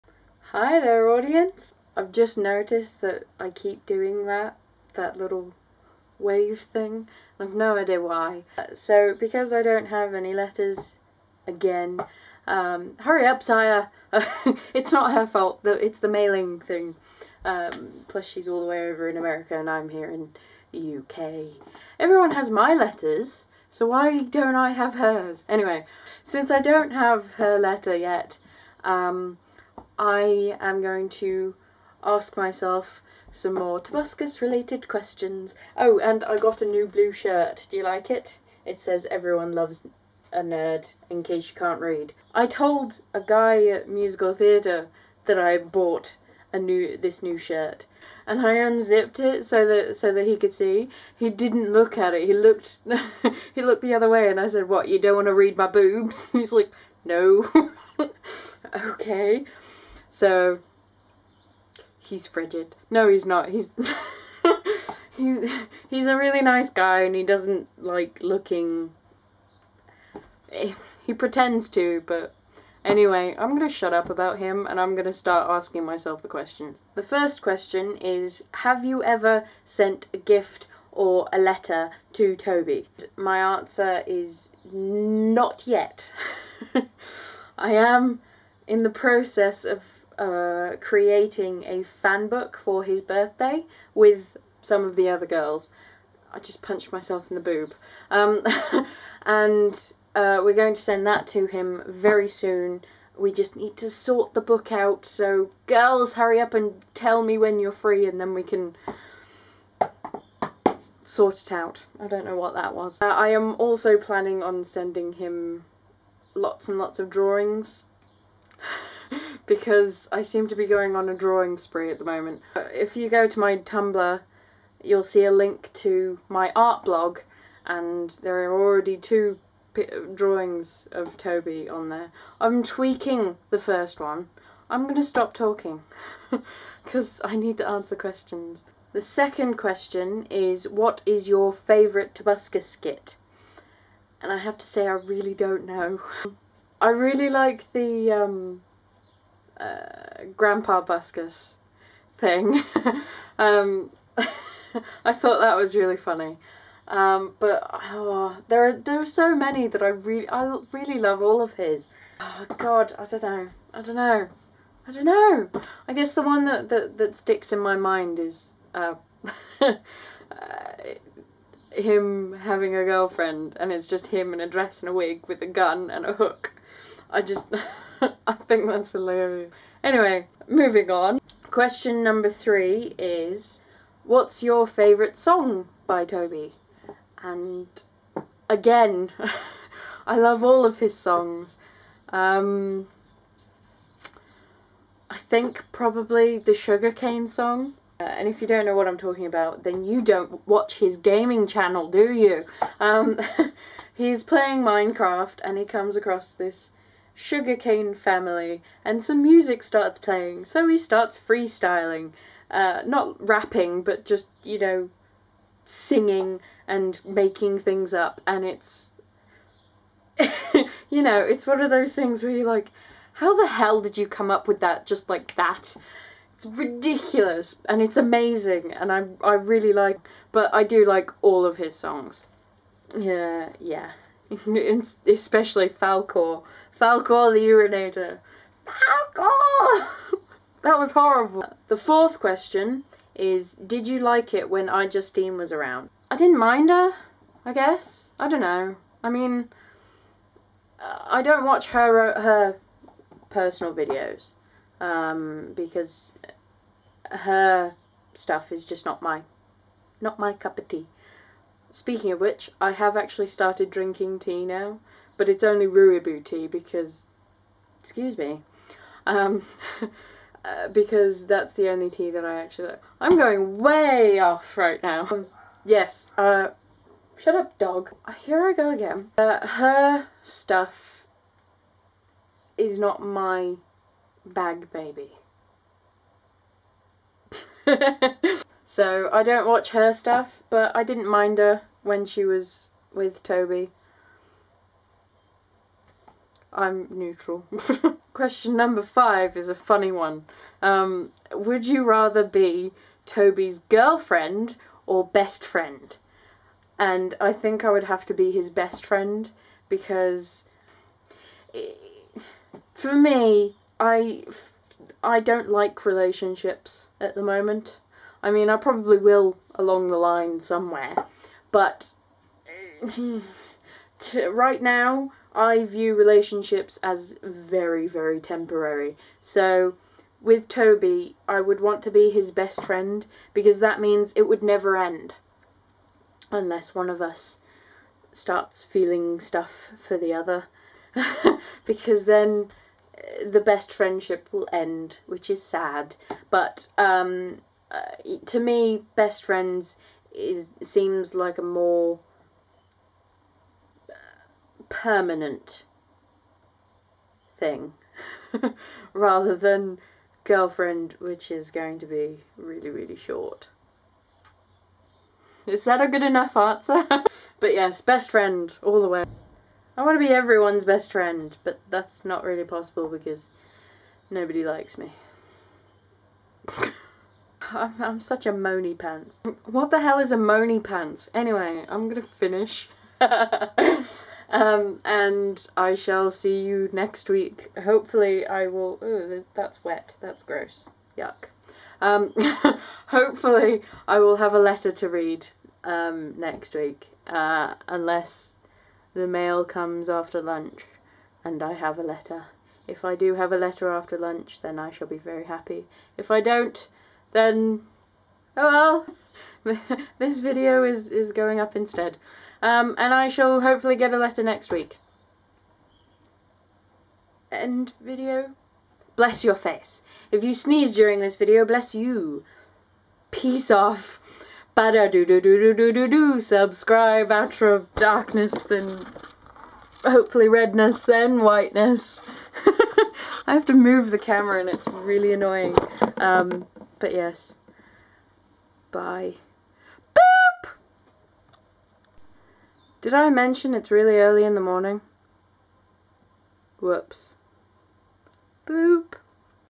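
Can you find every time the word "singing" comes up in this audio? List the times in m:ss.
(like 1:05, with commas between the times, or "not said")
3:35.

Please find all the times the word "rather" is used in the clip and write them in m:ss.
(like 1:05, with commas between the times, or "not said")
5:01, 5:58.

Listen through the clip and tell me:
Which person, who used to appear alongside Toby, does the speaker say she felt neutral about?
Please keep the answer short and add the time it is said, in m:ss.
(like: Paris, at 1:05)
iJustine, at 4:04.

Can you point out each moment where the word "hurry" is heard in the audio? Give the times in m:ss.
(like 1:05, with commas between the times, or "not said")
0:12, 1:46.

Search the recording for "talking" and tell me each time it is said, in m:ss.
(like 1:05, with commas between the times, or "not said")
2:15, 3:18.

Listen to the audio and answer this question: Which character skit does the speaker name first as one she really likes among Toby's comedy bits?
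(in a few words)
Grandpa Buskus.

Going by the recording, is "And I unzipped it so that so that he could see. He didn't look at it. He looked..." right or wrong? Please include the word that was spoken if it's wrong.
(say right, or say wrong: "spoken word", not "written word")
right.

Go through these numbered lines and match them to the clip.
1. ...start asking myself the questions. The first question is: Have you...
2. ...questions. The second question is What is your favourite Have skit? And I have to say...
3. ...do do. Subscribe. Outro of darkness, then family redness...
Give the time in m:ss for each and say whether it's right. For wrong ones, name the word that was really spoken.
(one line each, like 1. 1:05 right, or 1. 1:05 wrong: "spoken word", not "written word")
1. 1:15 right
2. 2:17 wrong: "Tobuscus", not "Have"
3. 7:05 wrong: "hopefully", not "family".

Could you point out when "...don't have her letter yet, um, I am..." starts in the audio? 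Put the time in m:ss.
0:26.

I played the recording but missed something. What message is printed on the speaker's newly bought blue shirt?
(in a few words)
Everyone loves a nerd.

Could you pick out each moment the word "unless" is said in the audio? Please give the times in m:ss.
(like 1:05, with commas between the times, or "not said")
5:36, 6:37.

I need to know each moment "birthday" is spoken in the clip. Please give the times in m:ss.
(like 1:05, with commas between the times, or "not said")
1:33.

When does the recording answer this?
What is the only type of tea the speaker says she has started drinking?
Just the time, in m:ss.
4:25.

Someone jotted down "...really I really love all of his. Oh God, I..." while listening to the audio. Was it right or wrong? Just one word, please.
right.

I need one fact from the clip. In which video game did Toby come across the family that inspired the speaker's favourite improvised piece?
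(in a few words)
Minecraft.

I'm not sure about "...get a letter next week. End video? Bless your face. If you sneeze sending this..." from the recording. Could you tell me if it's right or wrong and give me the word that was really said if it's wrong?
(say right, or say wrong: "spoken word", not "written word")
wrong: "during", not "sending".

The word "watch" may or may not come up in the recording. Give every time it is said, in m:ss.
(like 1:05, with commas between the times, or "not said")
3:20, 4:11, 4:49.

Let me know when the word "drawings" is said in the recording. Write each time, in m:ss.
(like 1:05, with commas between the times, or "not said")
1:57, 2:01, 2:10.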